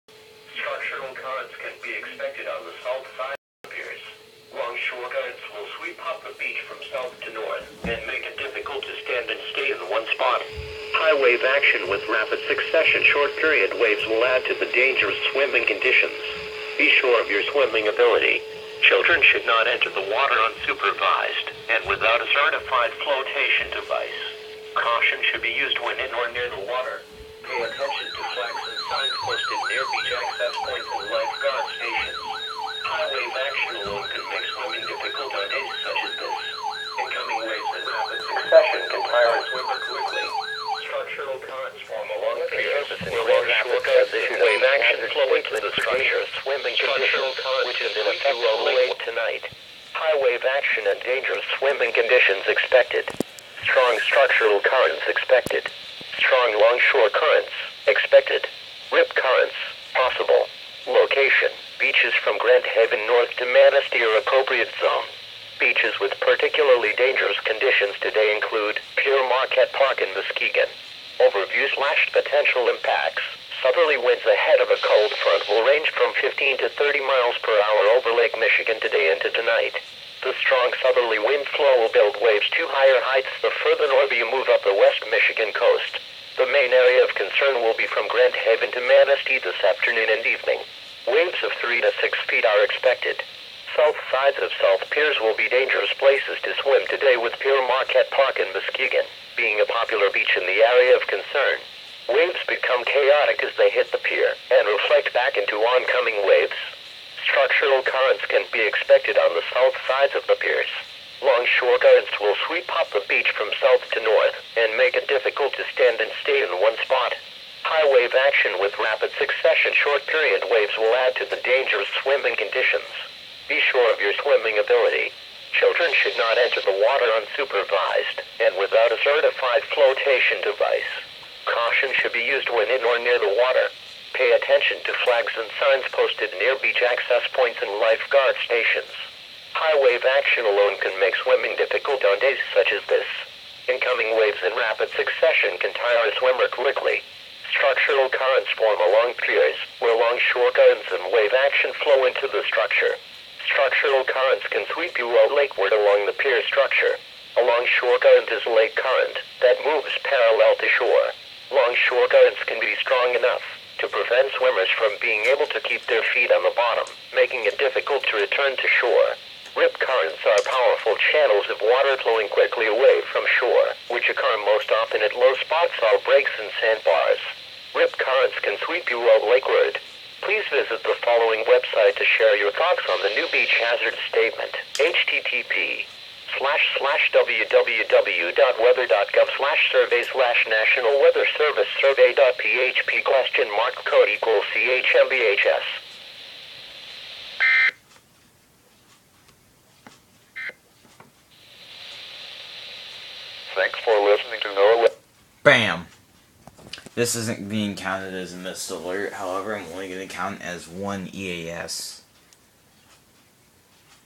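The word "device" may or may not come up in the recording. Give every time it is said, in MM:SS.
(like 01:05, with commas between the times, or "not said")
00:23, 02:10.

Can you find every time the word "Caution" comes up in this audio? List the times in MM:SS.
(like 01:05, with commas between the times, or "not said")
00:24, 02:11.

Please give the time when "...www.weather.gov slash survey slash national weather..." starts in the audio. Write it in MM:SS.
03:07.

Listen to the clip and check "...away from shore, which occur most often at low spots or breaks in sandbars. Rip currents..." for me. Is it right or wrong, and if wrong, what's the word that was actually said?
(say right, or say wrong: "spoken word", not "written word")
right.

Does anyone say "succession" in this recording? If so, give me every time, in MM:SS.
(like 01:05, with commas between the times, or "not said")
00:12, 01:59, 02:24.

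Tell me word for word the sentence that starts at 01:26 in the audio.
The main area of concern will be from Grand Haven to Manistee this afternoon and evening.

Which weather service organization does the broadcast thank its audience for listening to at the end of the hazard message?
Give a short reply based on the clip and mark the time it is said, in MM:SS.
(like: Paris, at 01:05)
NOAA, at 03:24.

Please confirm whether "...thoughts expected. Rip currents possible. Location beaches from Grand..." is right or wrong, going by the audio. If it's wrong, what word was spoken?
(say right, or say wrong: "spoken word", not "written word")
wrong: "currents", not "thoughts".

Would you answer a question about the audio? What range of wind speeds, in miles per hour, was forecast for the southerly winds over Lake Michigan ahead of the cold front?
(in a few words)
15 to 30.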